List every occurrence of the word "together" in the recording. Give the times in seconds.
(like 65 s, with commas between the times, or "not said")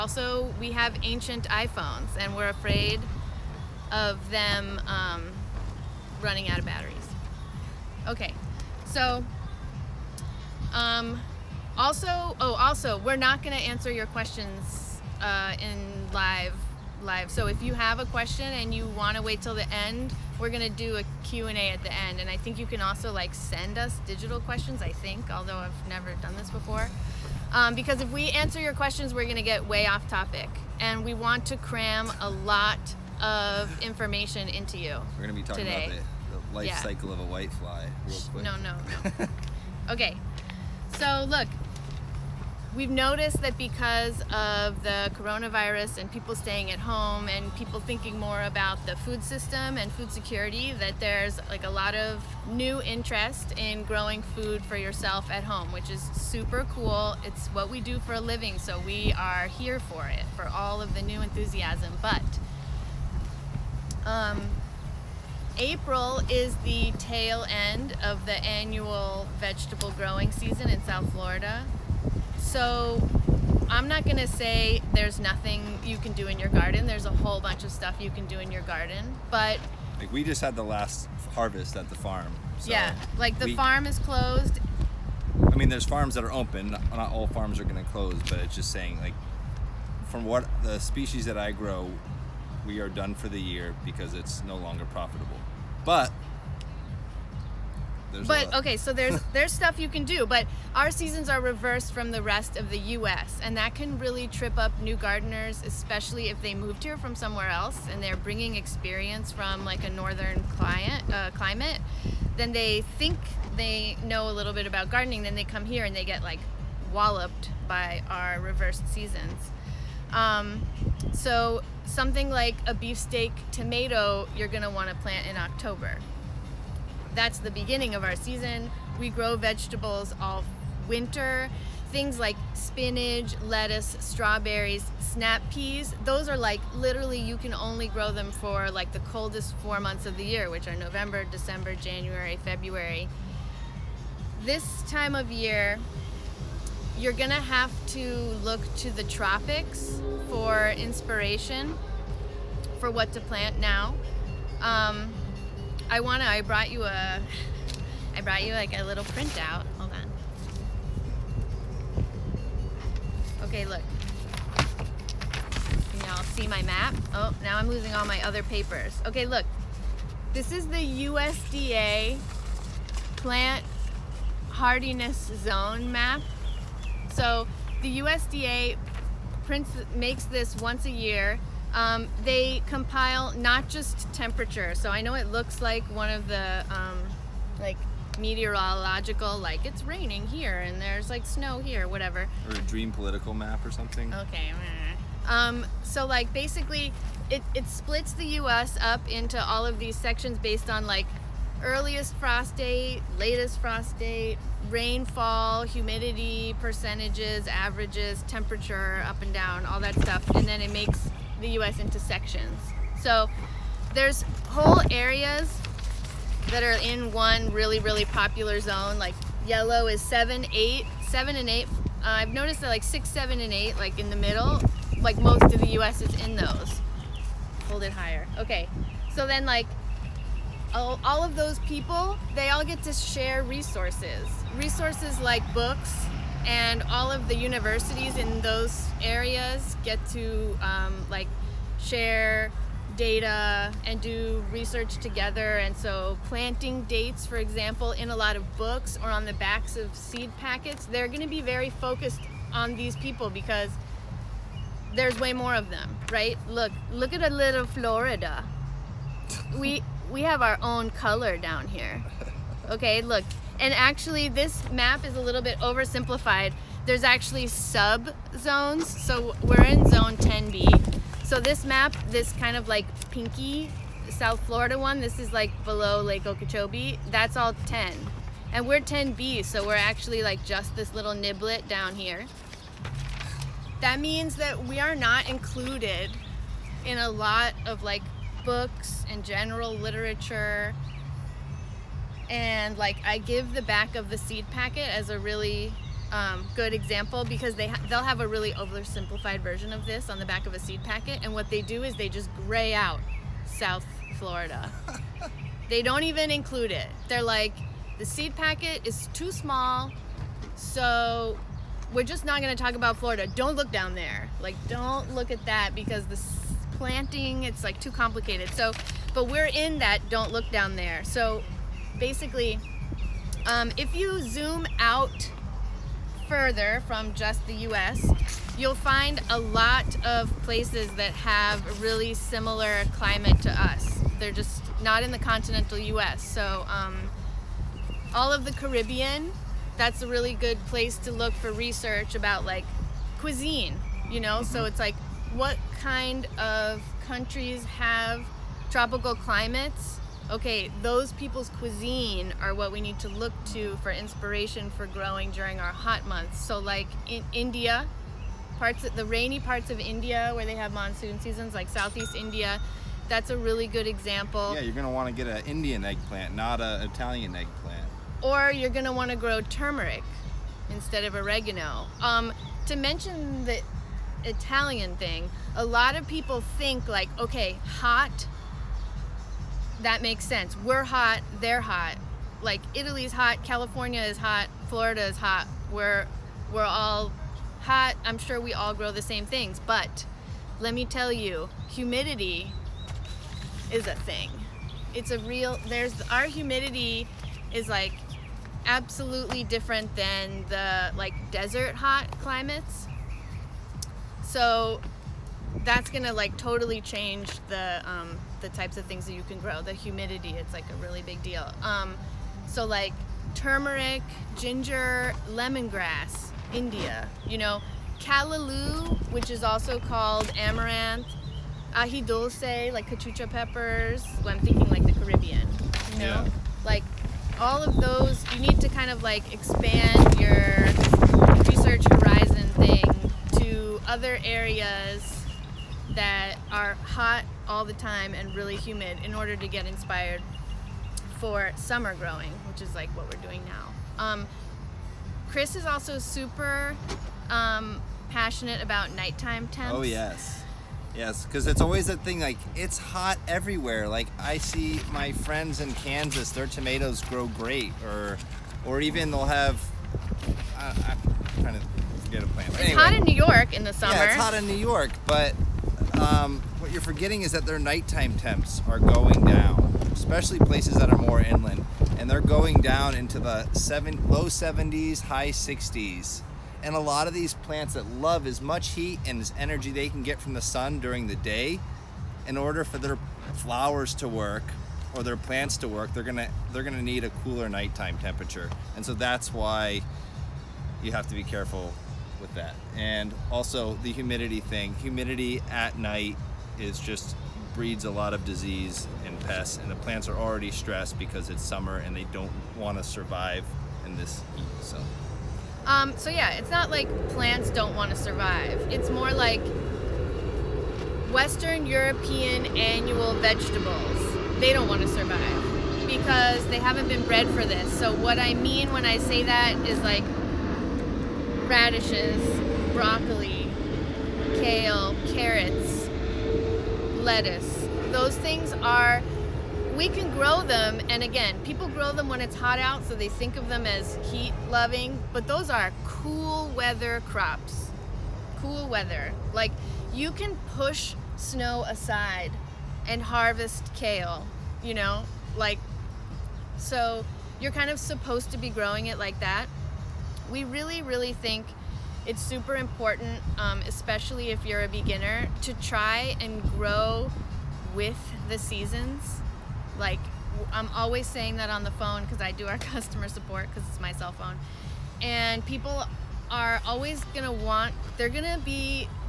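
244 s.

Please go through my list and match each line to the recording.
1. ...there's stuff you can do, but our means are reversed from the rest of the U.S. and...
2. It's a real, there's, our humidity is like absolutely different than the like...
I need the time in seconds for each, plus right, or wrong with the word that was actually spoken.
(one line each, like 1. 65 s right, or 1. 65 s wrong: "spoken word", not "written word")
1. 99 s wrong: "seasons", not "means"
2. 394 s right.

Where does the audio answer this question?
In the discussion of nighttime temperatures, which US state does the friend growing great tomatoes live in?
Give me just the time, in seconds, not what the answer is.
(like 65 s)
455 s.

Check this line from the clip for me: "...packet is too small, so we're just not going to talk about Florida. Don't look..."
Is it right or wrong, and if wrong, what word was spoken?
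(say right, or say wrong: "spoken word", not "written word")
right.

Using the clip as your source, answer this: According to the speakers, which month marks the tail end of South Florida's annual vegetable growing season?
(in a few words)
April.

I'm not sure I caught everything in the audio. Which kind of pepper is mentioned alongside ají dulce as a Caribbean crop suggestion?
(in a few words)
cachucha peppers.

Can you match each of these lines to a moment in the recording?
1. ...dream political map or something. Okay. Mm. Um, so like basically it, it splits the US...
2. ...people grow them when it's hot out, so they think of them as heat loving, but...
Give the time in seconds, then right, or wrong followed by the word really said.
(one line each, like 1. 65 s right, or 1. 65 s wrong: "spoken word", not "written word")
1. 192 s right
2. 531 s right.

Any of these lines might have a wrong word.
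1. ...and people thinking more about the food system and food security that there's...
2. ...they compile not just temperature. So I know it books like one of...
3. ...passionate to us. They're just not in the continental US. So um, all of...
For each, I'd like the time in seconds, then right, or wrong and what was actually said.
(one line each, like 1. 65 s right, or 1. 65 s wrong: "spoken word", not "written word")
1. 47 s right
2. 182 s wrong: "looks", not "books"
3. 332 s wrong: "climate", not "passionate".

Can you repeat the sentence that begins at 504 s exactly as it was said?
So um, so yeah, it's not like plants don't want to survive.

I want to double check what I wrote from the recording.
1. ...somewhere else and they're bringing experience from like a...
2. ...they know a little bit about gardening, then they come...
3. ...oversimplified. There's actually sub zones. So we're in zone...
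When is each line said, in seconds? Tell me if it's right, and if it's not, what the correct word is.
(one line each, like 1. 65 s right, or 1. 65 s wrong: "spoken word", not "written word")
1. 107 s right
2. 113 s right
3. 265 s right.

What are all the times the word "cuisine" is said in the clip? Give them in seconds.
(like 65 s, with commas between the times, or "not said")
343 s, 351 s.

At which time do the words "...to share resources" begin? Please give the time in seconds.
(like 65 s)
232 s.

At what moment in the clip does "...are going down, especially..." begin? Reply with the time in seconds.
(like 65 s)
468 s.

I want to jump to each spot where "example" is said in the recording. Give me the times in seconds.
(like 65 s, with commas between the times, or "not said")
247 s, 296 s, 363 s.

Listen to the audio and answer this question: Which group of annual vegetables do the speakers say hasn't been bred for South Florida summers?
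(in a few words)
Western European.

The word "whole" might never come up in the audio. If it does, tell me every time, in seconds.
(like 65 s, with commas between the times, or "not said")
77 s, 214 s.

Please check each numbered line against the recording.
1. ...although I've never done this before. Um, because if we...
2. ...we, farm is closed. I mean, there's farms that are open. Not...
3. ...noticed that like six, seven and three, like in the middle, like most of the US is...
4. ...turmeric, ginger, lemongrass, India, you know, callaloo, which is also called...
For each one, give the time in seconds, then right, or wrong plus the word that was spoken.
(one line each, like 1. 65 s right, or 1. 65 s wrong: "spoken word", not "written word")
1. 25 s right
2. 83 s right
3. 222 s wrong: "eight", not "three"
4. 413 s right.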